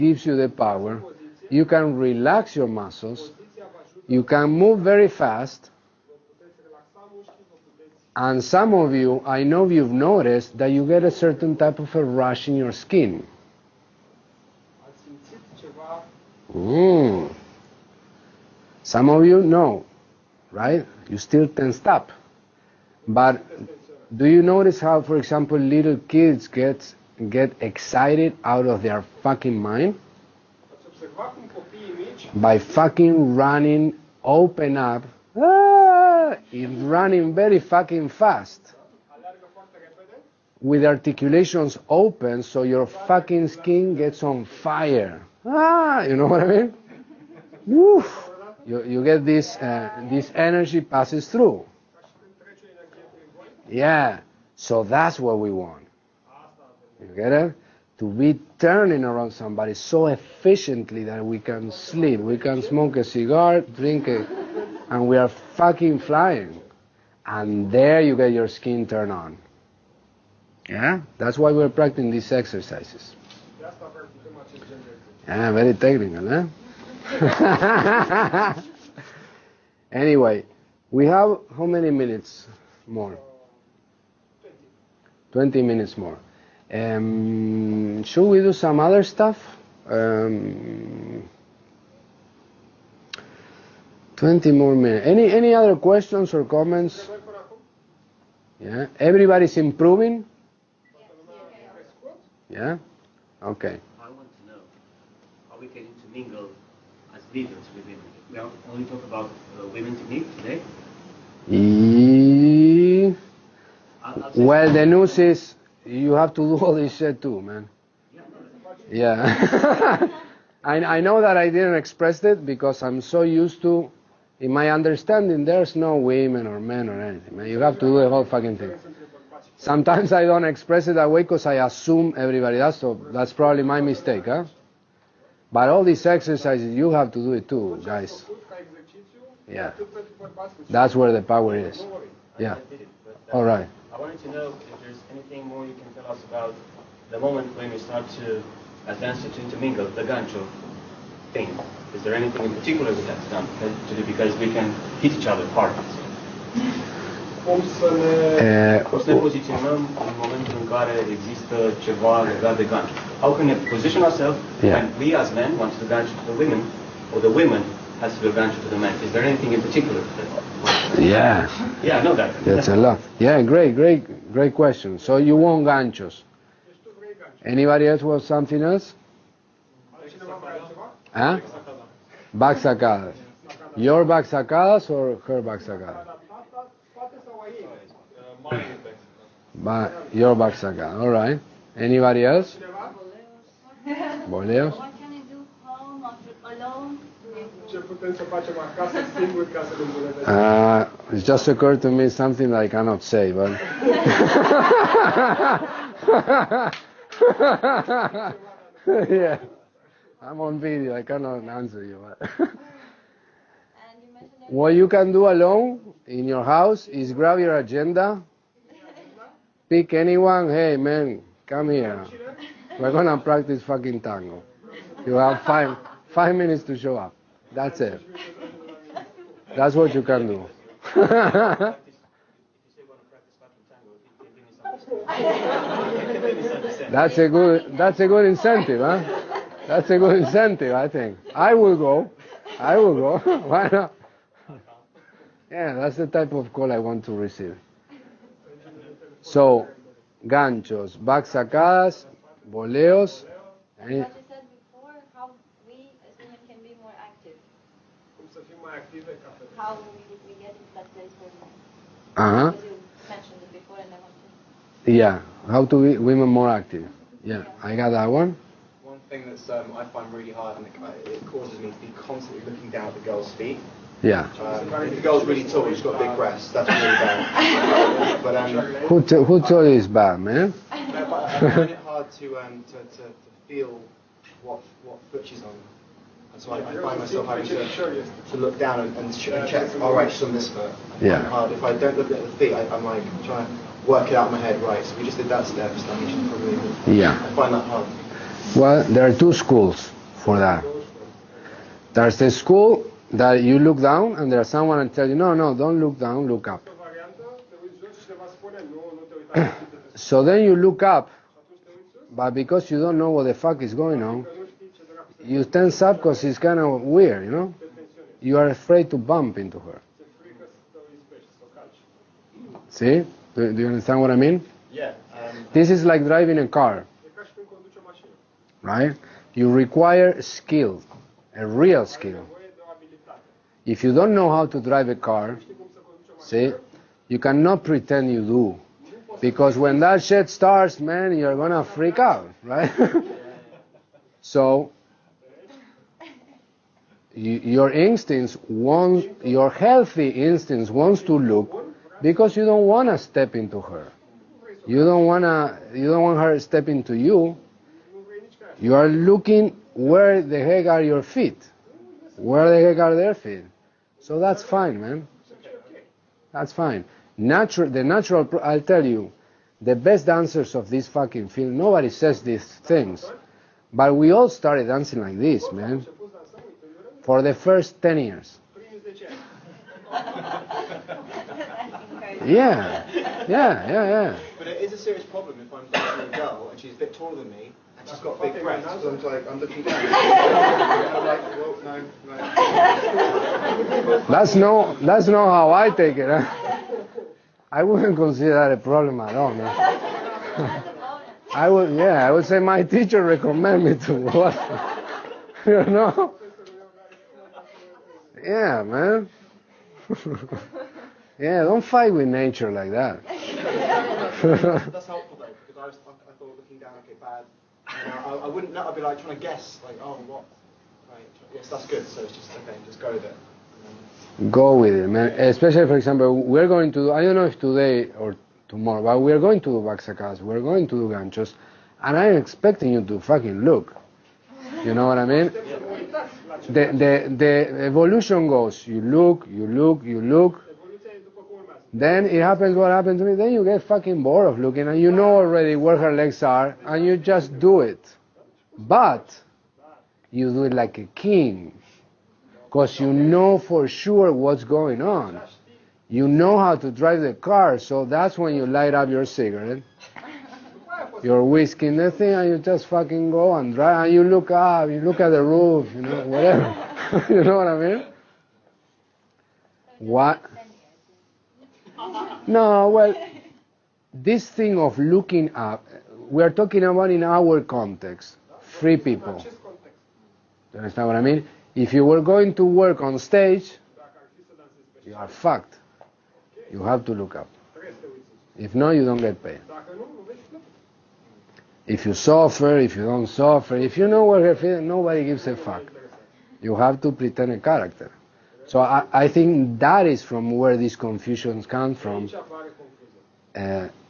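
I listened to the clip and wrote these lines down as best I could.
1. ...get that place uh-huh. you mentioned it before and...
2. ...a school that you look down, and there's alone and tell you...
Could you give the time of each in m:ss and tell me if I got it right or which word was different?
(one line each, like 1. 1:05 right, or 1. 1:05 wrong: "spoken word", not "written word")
1. 4:20 right
2. 5:02 wrong: "someone", not "alone".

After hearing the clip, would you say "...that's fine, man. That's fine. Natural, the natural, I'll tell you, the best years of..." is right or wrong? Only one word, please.
wrong.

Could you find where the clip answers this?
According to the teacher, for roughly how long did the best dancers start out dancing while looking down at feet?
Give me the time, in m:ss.
6:17.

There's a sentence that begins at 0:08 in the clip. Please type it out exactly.
And some of you, I know you've noticed that you get a certain type of a rash in your skin.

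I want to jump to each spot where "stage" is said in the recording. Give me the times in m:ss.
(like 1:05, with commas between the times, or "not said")
8:02.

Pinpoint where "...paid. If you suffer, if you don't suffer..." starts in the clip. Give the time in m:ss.
8:09.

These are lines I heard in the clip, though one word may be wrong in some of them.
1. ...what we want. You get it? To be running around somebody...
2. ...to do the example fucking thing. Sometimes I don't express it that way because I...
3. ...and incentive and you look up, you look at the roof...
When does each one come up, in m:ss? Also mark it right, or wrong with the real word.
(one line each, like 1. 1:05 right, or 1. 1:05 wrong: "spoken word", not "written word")
1. 0:55 wrong: "turning", not "running"
2. 2:07 wrong: "whole", not "example"
3. 7:43 wrong: "drive", not "incentive".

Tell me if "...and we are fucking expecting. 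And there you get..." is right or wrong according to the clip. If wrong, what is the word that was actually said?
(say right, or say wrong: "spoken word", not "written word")
wrong: "flying", not "expecting".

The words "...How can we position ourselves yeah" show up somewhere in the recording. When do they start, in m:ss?
2:43.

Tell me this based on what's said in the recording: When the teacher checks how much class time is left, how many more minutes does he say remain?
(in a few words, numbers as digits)
20.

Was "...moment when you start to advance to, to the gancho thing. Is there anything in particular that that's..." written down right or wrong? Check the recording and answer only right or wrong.
right.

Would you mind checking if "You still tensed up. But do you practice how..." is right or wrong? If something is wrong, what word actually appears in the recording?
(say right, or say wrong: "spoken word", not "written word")
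wrong: "notice", not "practice".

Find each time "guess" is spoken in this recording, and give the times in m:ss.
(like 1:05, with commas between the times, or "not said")
6:59.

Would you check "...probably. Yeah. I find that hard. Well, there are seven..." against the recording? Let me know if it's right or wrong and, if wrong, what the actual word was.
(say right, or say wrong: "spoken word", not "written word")
wrong: "two", not "seven".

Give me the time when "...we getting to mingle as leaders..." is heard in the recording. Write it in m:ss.
1:45.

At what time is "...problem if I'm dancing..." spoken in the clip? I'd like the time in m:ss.
6:25.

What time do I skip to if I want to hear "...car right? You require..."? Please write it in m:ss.
5:26.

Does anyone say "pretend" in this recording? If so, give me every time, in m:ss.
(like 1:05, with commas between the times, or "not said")
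5:37, 8:16.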